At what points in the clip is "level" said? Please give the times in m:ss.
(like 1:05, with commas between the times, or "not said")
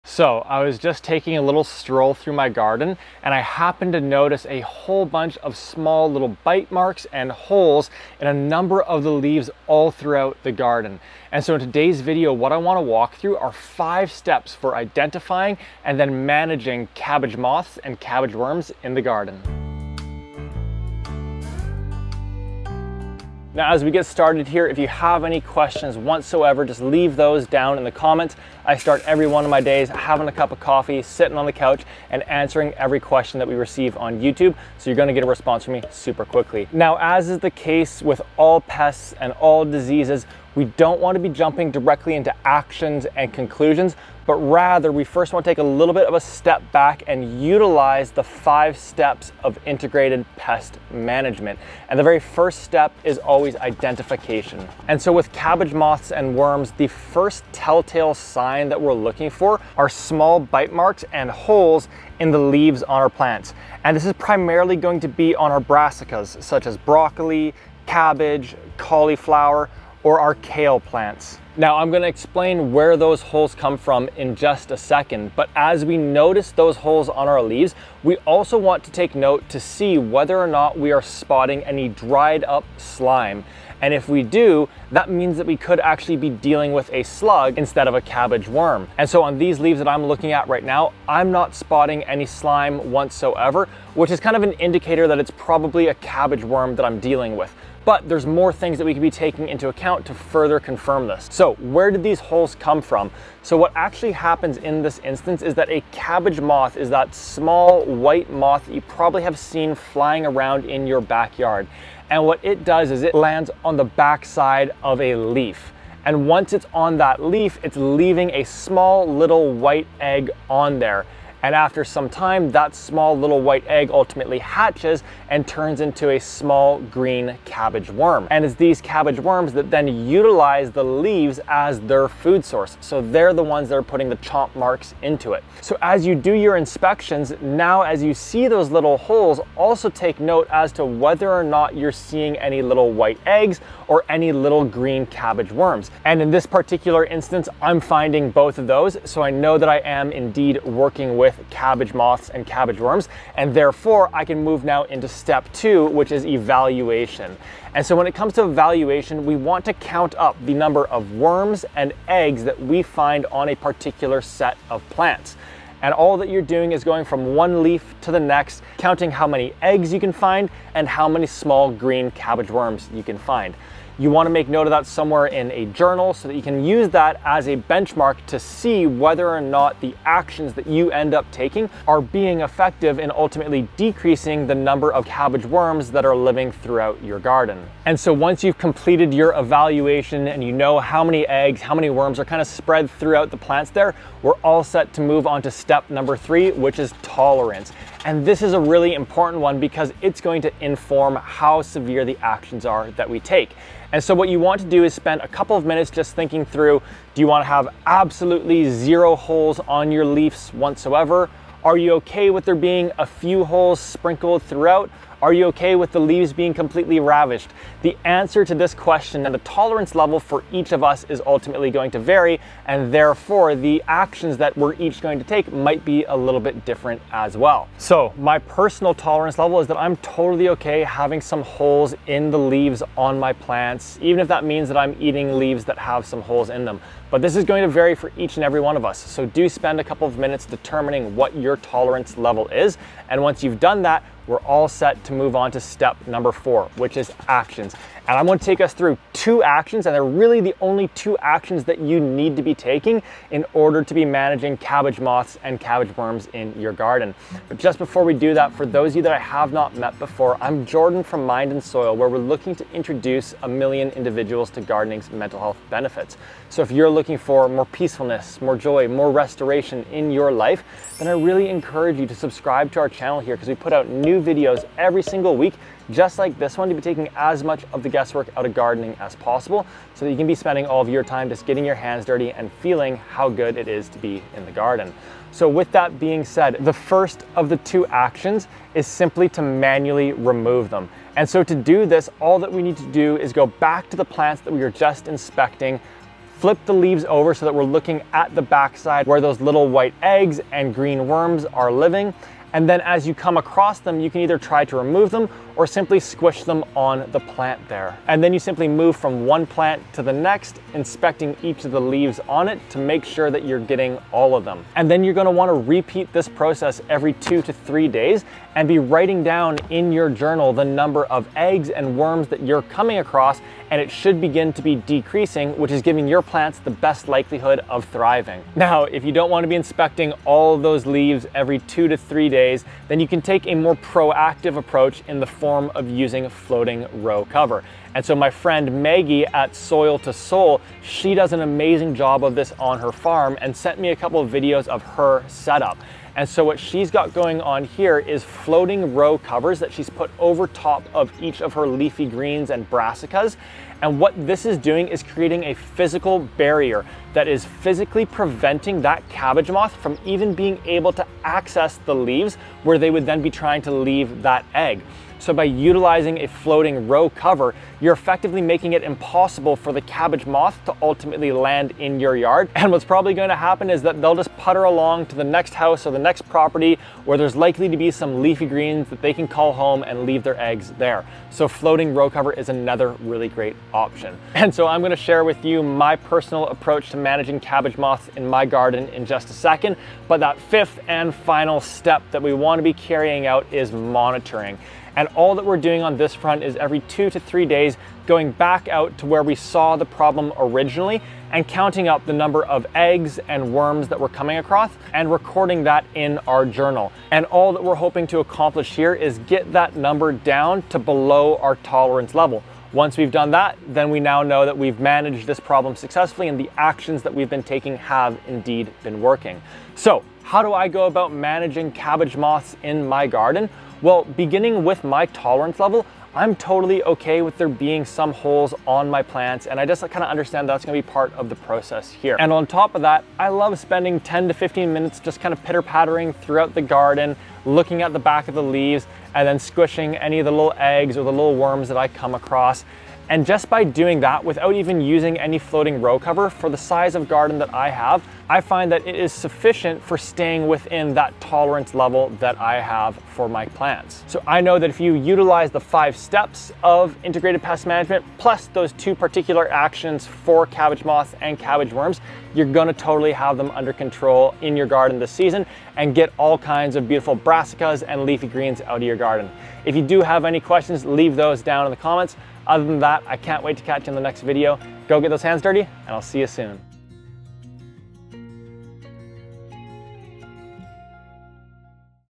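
3:39, 3:49, 4:02, 6:52, 7:05, 7:31.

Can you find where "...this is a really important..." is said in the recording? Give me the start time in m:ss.
3:18.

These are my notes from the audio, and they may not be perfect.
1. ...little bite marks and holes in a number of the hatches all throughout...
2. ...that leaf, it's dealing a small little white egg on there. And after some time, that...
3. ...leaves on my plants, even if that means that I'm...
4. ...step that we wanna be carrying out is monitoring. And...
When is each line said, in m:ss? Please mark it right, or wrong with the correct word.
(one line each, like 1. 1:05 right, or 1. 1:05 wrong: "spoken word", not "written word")
1. 0:06 wrong: "leaves", not "hatches"
2. 1:56 wrong: "leaving", not "dealing"
3. 3:52 right
4. 6:31 right.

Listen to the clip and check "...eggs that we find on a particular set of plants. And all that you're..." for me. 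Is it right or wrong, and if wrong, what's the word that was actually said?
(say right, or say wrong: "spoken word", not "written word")
right.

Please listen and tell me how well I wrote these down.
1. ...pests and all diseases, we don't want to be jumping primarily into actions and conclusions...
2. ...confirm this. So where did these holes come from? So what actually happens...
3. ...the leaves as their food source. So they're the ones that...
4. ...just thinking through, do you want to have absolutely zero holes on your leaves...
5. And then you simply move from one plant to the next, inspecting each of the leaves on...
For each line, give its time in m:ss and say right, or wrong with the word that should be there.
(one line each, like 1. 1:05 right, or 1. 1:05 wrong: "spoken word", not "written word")
1. 0:38 wrong: "directly", not "primarily"
2. 1:40 right
3. 2:10 right
4. 3:25 right
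5. 5:08 right.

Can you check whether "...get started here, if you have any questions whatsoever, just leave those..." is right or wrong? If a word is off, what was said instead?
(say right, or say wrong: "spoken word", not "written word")
right.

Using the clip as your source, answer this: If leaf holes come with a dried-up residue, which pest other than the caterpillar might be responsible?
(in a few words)
A slug.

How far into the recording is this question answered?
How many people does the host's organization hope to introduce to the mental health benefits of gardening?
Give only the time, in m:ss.
4:23.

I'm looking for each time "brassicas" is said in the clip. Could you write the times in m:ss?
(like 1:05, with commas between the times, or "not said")
1:05, 5:52, 7:47.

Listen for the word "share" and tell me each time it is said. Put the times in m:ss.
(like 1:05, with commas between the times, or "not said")
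6:24.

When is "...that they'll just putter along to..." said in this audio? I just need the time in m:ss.
6:13.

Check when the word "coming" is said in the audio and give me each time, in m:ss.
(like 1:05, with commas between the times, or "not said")
5:22, 6:44.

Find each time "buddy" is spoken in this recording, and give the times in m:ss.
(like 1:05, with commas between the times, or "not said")
not said.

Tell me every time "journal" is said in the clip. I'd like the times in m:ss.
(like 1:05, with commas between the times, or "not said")
2:55, 5:20, 6:46.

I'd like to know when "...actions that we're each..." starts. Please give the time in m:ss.
3:43.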